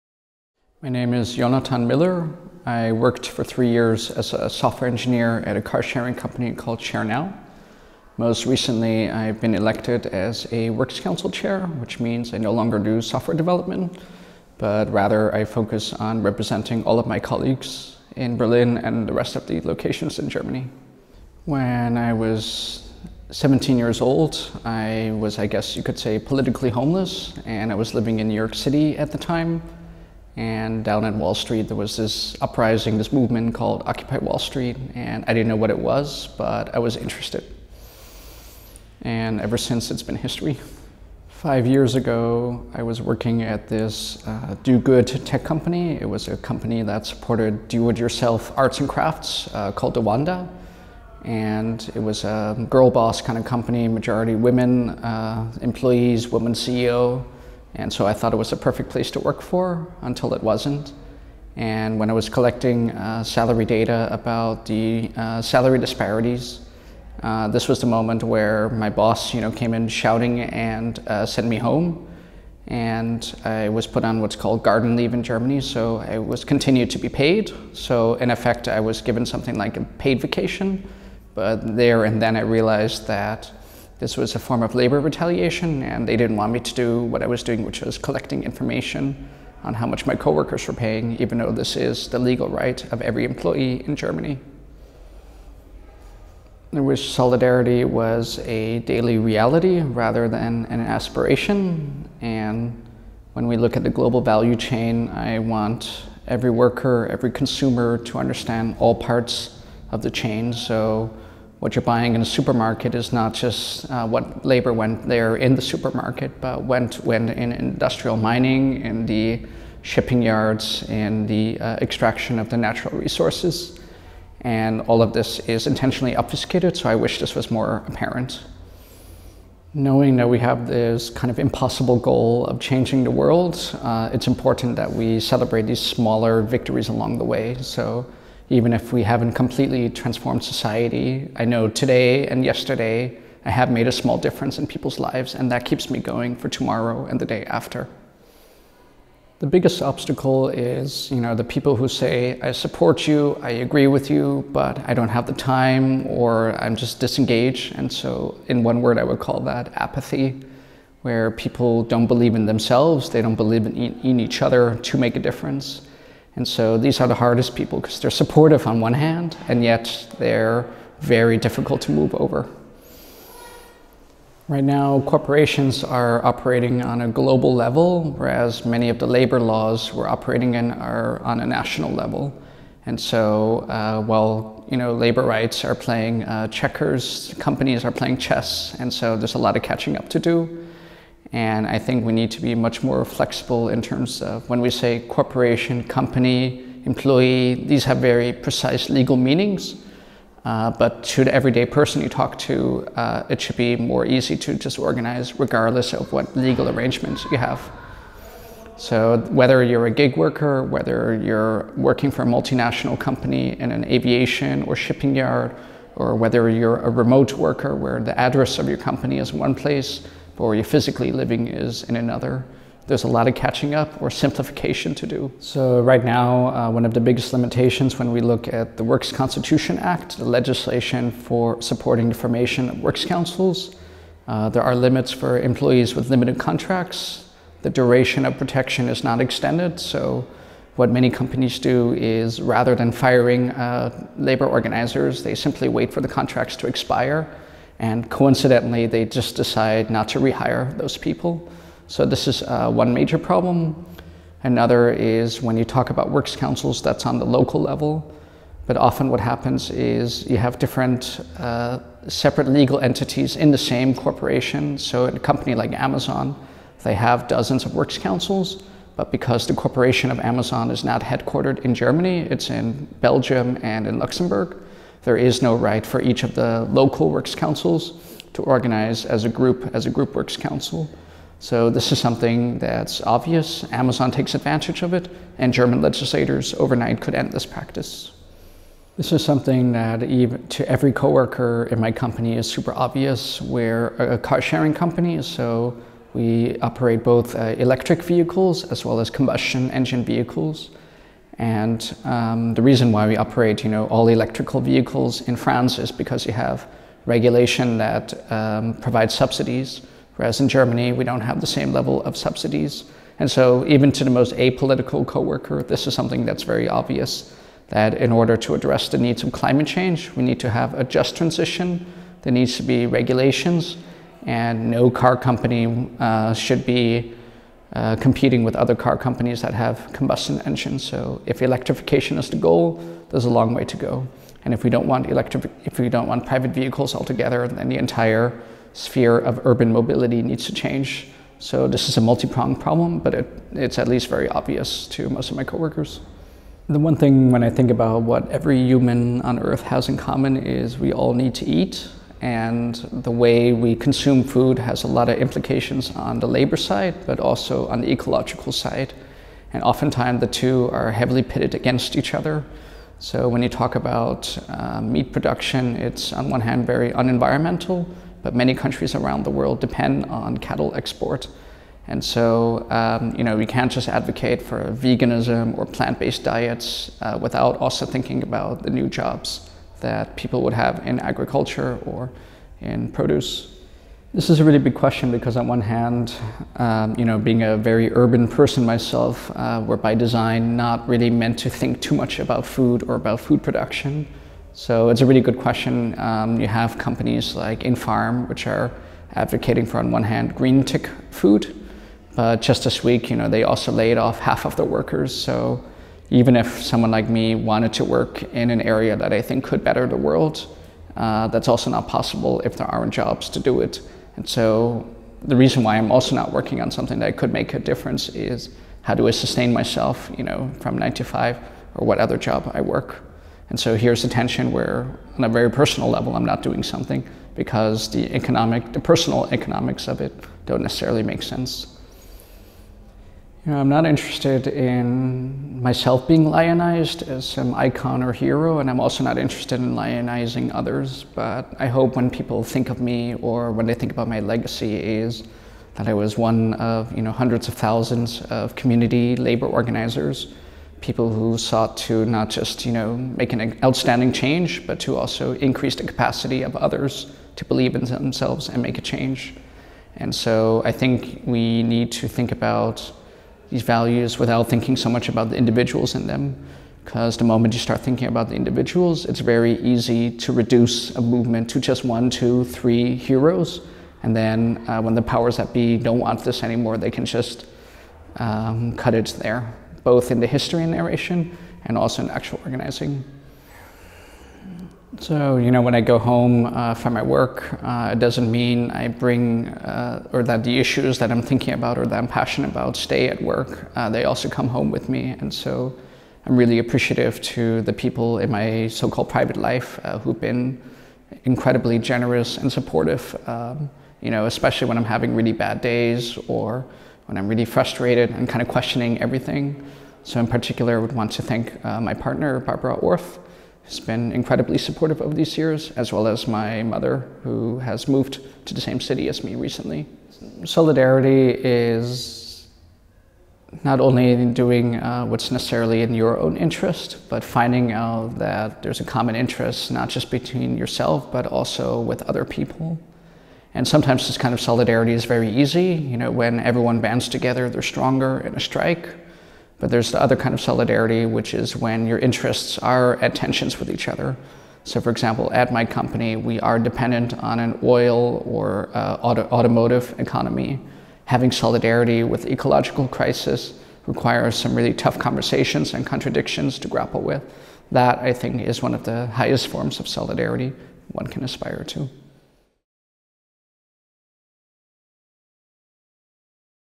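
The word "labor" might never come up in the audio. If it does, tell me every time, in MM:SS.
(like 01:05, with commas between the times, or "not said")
01:24, 01:54, 02:59, 03:04, 04:04, 05:56, 07:29.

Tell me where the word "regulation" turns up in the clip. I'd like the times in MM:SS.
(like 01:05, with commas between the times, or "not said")
05:07, 05:22.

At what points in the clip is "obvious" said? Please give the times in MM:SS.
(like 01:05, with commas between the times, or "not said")
04:43, 04:52, 05:16, 05:44.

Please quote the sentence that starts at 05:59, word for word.
And oftentimes the two are heavily pitted against each other.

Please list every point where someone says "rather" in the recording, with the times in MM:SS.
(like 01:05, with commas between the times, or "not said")
00:14, 01:39, 04:02.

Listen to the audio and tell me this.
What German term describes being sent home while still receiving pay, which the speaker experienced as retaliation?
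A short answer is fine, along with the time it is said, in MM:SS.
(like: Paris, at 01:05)
garden leave, at 01:14.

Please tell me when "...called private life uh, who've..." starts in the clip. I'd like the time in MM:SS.
08:18.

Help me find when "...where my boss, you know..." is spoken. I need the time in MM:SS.
01:08.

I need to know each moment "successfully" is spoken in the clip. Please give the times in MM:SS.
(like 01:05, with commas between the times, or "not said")
not said.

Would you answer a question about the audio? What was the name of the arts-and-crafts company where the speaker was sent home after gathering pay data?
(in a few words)
DaWanda.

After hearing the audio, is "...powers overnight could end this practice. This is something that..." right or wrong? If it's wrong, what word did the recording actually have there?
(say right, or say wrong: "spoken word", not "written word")
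wrong: "legislators", not "powers".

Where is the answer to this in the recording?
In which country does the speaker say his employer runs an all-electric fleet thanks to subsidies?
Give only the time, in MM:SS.
05:05.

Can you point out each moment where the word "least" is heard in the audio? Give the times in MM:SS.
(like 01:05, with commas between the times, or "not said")
05:43.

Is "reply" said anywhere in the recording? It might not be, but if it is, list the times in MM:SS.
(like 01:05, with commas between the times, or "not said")
not said.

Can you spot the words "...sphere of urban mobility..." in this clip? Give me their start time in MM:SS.
05:38.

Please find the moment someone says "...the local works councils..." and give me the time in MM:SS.
04:36.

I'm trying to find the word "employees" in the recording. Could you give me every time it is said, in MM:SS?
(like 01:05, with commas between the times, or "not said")
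00:55, 01:33, 03:16, 03:55.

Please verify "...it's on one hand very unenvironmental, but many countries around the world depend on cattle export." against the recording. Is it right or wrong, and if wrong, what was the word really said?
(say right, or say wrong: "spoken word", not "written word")
right.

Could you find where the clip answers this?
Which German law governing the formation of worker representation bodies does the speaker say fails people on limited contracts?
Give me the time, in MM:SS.
03:48.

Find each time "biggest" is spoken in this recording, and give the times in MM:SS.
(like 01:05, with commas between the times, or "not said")
02:29, 03:46.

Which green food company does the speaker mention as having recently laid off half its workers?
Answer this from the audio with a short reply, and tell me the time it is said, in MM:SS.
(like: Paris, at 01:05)
InFarm, at 06:37.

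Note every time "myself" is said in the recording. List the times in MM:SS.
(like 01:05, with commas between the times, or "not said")
06:28, 06:59, 07:15.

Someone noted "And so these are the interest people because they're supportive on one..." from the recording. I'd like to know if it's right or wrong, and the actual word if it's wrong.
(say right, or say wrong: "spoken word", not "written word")
wrong: "hardest", not "interest".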